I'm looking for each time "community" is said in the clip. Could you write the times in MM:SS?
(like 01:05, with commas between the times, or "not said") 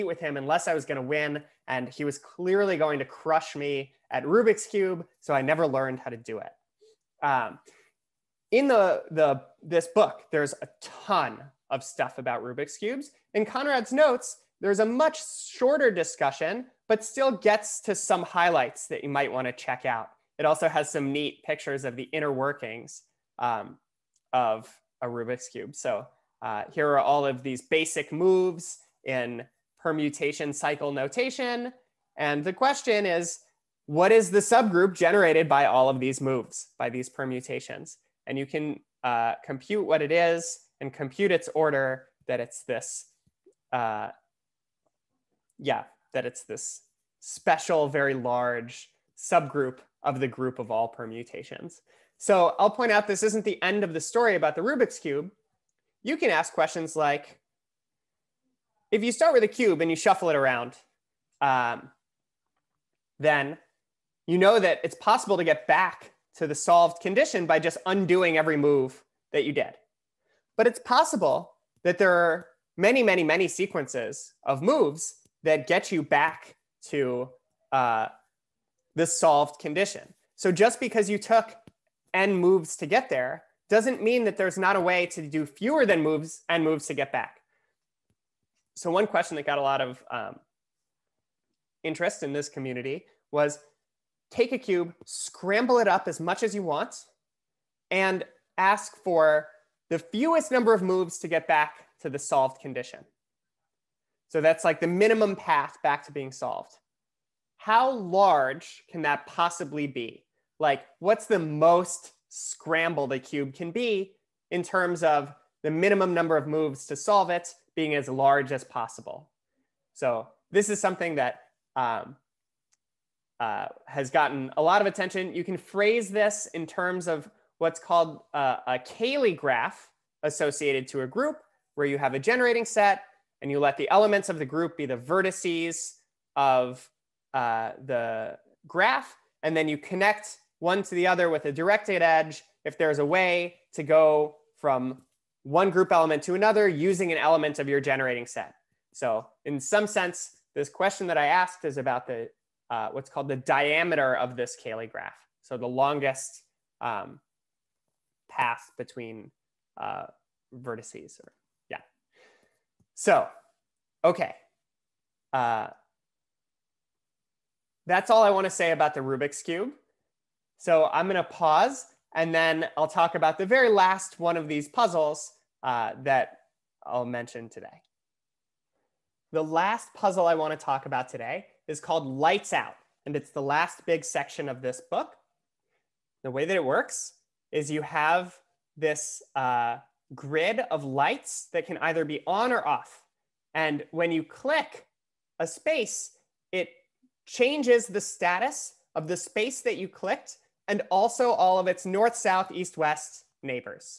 01:32.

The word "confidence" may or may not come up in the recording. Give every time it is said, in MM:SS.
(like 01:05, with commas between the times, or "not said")
not said.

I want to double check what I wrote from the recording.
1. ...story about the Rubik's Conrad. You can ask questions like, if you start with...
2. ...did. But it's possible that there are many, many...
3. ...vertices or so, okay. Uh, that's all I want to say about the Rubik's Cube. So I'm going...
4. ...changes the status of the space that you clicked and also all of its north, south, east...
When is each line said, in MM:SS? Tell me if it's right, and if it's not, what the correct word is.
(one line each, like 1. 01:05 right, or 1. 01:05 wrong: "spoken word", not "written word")
1. 00:54 wrong: "Cube", not "Conrad"
2. 01:09 right
3. 02:40 right
4. 03:17 right.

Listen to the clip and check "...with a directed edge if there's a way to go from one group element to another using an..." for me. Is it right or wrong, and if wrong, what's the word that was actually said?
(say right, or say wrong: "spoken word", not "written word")
right.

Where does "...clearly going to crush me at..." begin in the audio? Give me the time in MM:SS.
00:02.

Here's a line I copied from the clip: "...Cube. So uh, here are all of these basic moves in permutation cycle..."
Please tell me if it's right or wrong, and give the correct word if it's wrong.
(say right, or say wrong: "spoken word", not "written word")
right.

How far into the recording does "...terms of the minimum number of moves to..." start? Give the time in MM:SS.
01:54.